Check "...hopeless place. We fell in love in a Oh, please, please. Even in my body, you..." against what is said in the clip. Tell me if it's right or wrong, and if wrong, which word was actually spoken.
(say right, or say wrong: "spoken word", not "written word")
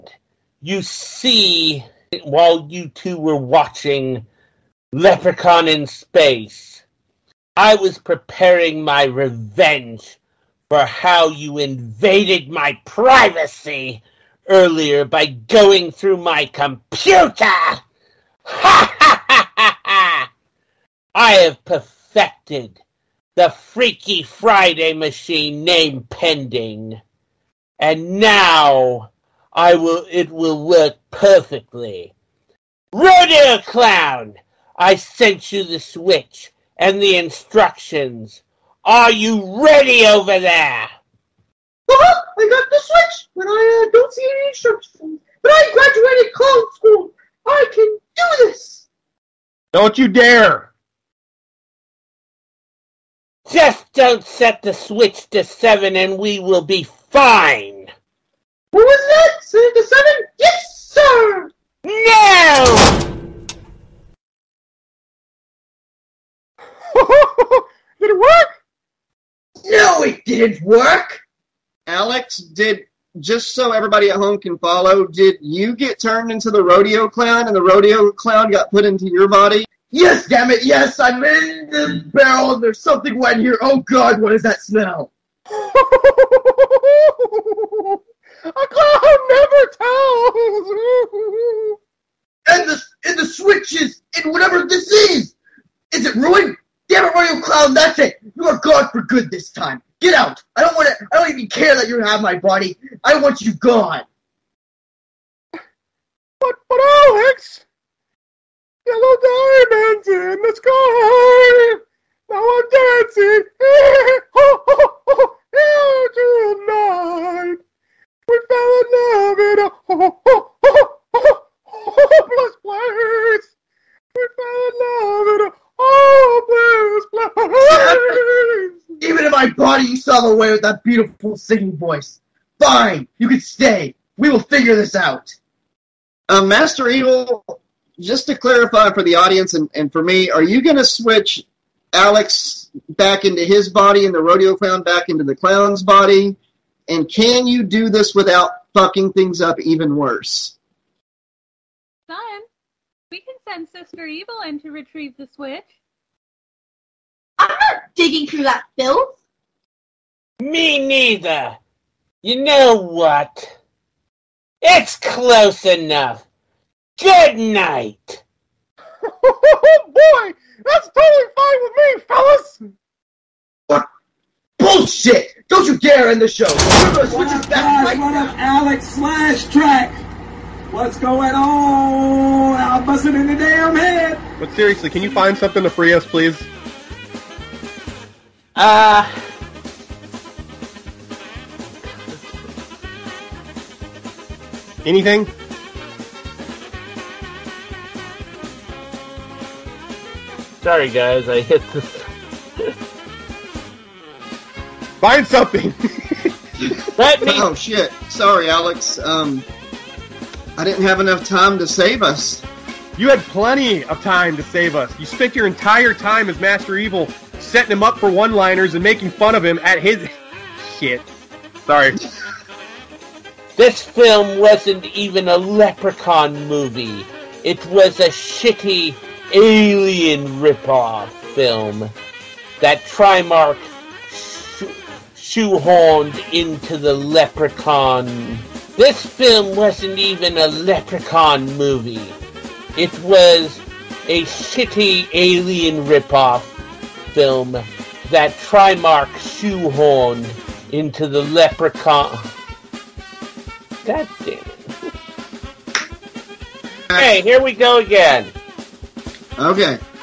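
right.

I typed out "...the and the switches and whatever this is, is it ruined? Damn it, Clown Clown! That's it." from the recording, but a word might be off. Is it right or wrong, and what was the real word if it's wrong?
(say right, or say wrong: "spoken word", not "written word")
wrong: "Rodeo", not "Clown".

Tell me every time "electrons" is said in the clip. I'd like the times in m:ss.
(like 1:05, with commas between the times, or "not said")
not said.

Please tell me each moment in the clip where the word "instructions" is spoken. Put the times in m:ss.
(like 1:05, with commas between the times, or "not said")
0:37, 0:44.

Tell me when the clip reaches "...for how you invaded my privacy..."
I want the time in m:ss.
0:10.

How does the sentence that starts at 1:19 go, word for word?
Yes, damn it, yes, I'm in the barrel and there's something wet here.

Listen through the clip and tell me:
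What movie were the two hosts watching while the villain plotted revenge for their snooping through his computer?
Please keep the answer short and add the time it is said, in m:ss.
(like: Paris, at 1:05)
Leprechaun in Space, at 0:04.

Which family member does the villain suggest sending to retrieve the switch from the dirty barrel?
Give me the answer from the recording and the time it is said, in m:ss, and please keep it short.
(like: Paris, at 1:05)
Sister Evil, at 2:33.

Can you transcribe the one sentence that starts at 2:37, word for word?
I'm not digging through that filth.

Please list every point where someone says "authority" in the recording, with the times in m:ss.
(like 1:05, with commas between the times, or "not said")
not said.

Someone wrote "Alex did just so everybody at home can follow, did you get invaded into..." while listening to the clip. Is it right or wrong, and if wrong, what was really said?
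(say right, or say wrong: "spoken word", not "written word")
wrong: "turned", not "invaded".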